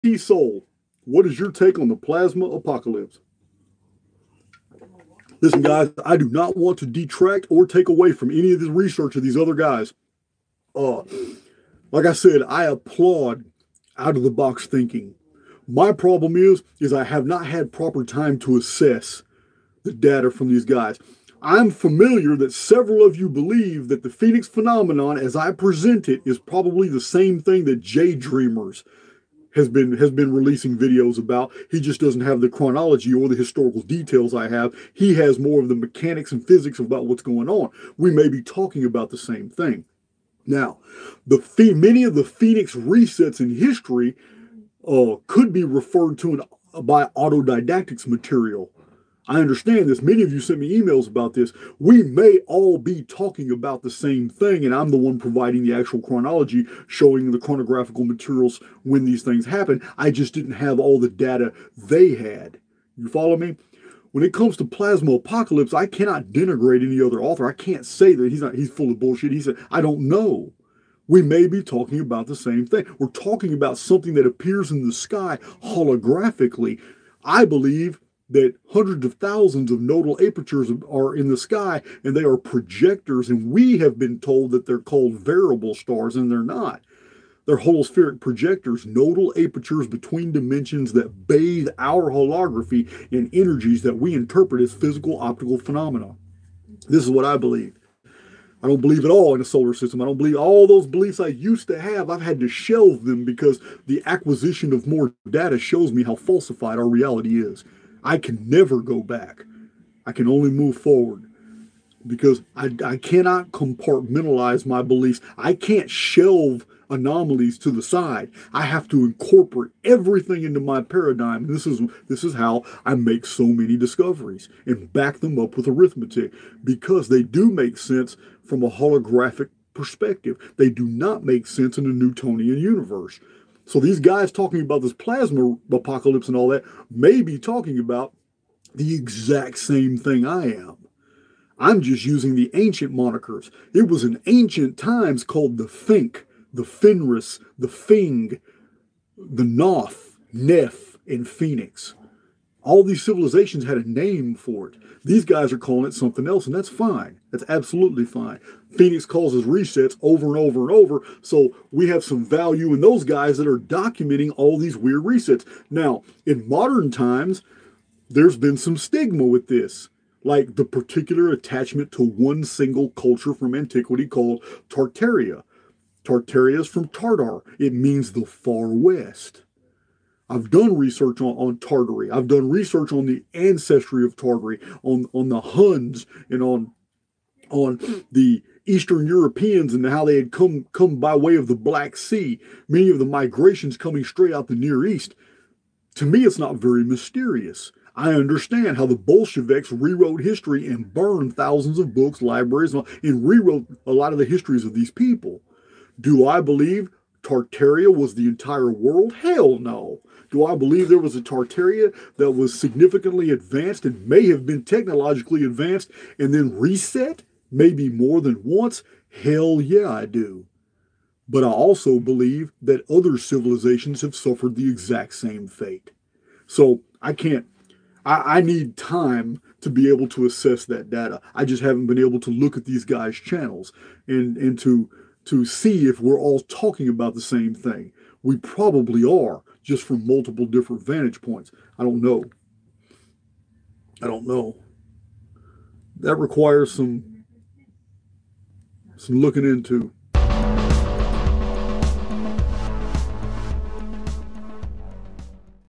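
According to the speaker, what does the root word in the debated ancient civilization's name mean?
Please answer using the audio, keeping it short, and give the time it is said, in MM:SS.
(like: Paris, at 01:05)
The far west, at 02:58.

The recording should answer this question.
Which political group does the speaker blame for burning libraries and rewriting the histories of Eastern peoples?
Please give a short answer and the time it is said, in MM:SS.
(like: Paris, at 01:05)
The Bolsheviks, at 03:18.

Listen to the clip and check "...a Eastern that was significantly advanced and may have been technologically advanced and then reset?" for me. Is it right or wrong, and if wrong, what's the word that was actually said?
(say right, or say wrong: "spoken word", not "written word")
wrong: "Tartaria", not "Eastern".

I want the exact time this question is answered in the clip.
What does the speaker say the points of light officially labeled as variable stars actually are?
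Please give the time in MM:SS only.
01:27.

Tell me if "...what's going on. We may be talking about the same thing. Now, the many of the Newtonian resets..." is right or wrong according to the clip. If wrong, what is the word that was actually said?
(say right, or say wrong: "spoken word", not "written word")
wrong: "Phoenix", not "Newtonian".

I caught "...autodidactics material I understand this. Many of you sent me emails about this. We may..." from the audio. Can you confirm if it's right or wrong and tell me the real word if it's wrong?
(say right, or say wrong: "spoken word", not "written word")
right.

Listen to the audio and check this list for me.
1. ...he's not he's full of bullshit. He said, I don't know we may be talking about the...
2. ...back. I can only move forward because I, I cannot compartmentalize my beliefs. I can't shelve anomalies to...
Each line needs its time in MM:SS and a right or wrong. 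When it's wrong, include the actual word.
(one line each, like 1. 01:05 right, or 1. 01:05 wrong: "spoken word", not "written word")
1. 01:08 right
2. 01:49 right.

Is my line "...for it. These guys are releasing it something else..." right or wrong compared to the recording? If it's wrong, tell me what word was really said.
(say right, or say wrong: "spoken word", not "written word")
wrong: "calling", not "releasing".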